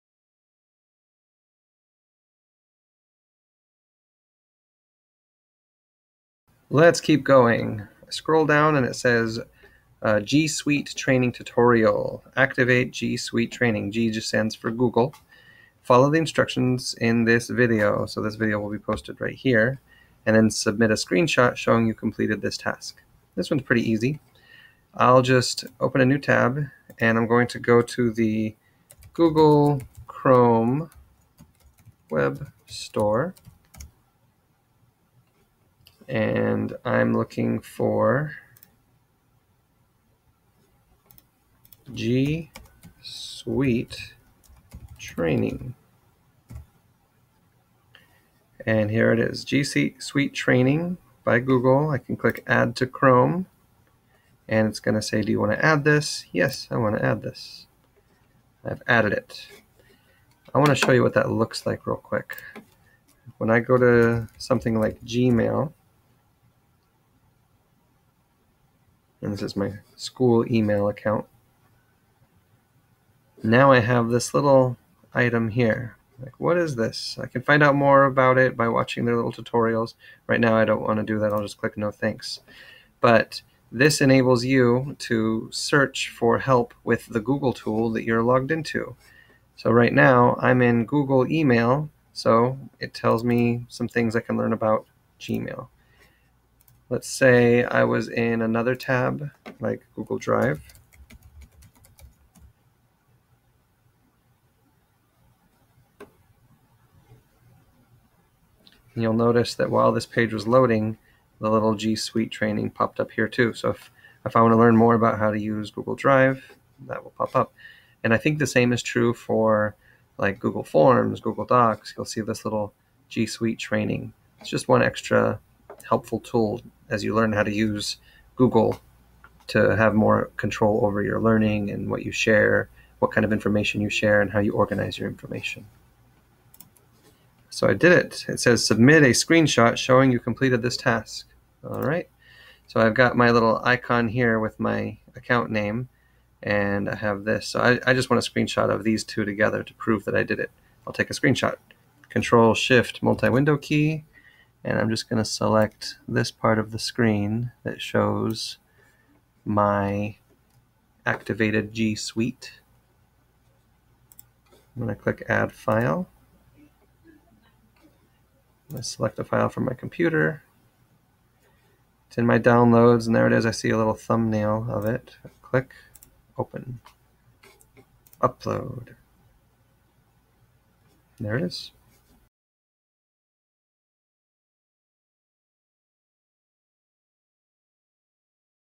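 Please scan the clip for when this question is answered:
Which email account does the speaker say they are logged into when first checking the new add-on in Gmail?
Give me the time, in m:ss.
1:09.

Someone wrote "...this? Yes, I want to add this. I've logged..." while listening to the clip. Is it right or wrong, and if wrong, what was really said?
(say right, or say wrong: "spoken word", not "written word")
wrong: "added", not "logged".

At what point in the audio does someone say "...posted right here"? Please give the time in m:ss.
0:18.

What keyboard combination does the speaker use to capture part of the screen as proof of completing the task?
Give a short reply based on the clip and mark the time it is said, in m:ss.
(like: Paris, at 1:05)
Control Shift Multi Window key, at 2:32.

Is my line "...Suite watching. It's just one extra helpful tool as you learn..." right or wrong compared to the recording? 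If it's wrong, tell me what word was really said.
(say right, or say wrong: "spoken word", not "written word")
wrong: "training", not "watching".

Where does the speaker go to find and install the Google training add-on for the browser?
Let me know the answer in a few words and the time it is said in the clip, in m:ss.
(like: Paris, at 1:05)
Google Chrome Web Store, at 0:29.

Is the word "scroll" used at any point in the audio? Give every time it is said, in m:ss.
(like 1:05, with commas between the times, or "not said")
0:08.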